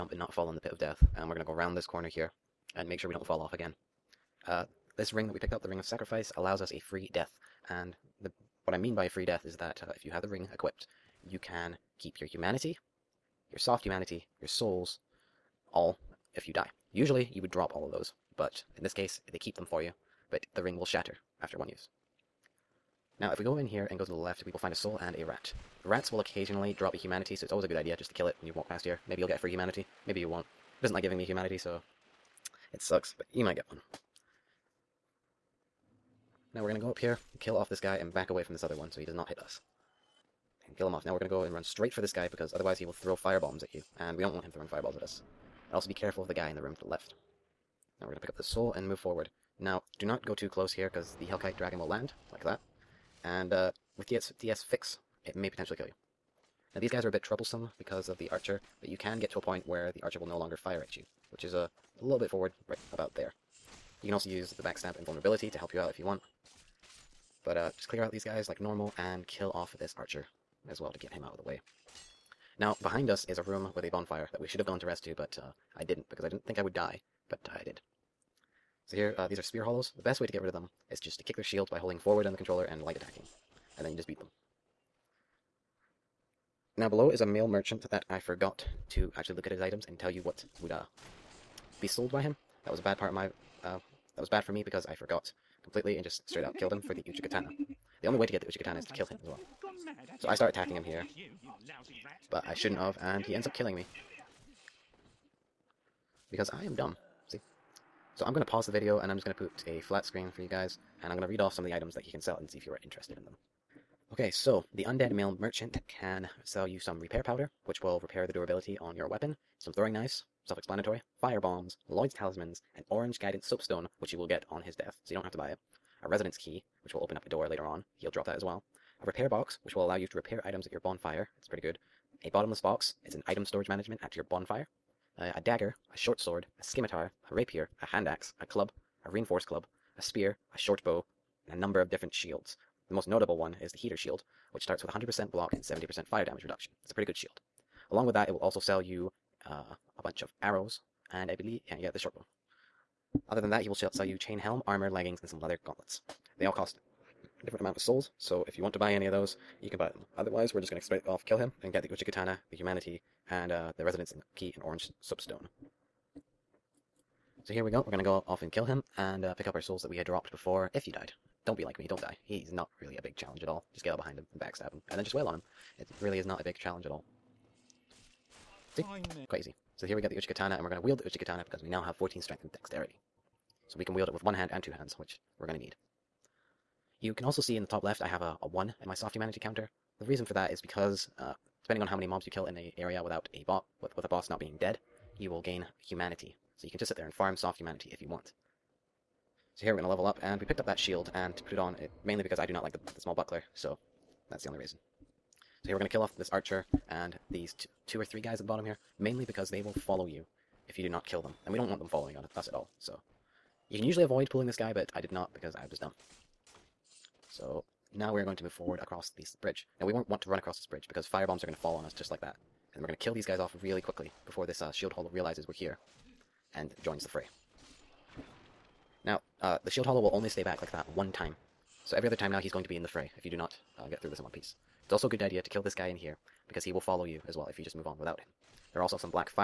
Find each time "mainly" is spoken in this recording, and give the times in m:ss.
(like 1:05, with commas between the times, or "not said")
3:22, 3:28.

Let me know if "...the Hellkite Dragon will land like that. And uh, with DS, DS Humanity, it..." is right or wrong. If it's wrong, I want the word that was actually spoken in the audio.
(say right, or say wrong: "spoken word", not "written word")
wrong: "Fix", not "Humanity".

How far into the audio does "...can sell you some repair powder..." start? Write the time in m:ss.
1:55.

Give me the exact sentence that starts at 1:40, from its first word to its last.
So I start attacking him here, but I shouldn't have, and he ends up killing me.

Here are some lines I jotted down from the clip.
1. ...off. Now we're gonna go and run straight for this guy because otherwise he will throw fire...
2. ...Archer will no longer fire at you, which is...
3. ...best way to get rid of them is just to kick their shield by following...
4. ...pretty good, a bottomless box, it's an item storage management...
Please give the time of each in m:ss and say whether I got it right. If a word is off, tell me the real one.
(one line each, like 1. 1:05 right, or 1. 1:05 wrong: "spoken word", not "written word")
1. 0:40 right
2. 1:00 right
3. 1:20 wrong: "holding", not "following"
4. 2:11 right.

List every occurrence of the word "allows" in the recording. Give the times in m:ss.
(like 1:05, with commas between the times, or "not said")
0:06, 2:09.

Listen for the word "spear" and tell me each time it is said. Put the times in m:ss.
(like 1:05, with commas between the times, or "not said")
1:19, 2:20.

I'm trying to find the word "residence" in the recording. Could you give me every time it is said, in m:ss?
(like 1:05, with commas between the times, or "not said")
2:06, 2:43.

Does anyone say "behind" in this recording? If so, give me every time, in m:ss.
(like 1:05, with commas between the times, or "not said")
1:12, 2:53.